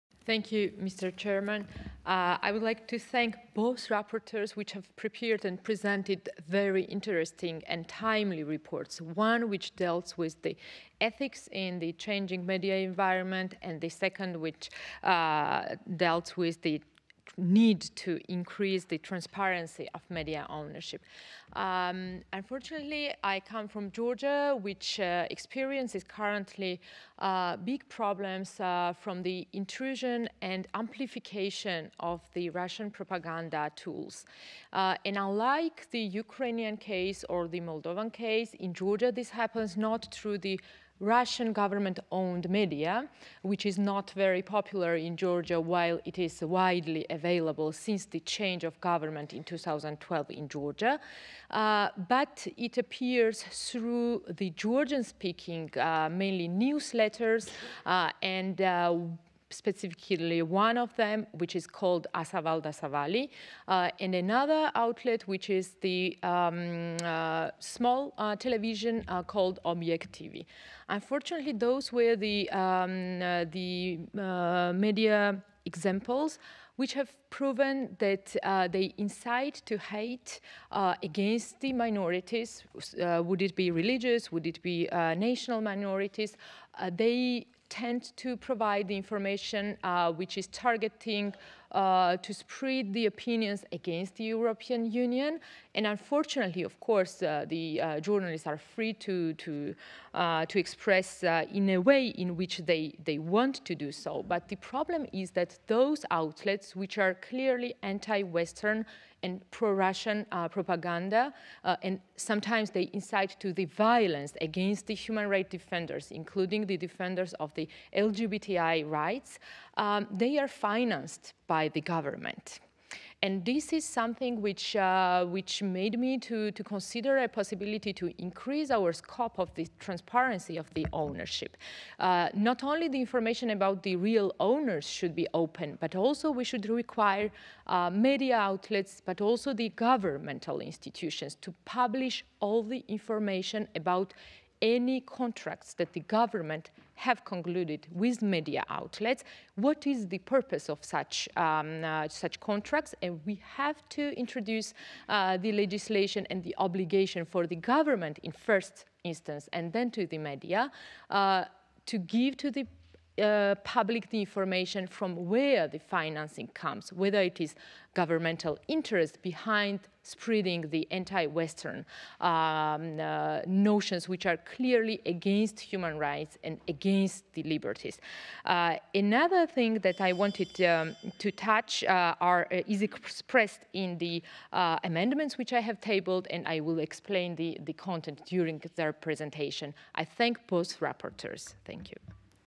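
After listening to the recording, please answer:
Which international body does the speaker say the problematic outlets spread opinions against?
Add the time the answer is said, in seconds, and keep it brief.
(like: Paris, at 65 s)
European Union, at 94 s.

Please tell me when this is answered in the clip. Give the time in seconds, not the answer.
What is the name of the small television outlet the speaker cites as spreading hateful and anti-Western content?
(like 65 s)
69 s.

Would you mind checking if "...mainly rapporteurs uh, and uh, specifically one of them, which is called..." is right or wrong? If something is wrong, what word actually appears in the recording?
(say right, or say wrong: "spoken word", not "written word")
wrong: "newsletters", not "rapporteurs".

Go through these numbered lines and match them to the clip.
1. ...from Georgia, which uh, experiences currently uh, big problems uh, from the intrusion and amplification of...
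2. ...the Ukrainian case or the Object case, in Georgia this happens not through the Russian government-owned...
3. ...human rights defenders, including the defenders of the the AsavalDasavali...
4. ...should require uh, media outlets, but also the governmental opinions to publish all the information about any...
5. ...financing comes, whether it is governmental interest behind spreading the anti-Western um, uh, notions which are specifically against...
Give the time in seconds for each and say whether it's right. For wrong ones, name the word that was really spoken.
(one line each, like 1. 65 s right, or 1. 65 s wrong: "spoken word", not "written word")
1. 23 s right
2. 35 s wrong: "Moldovan", not "Object"
3. 114 s wrong: "LGBTI", not "AsavalDasavali"
4. 136 s wrong: "institutions", not "opinions"
5. 165 s wrong: "clearly", not "specifically".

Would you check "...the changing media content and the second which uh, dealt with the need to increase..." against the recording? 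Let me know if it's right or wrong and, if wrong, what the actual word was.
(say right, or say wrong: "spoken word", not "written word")
wrong: "environment", not "content".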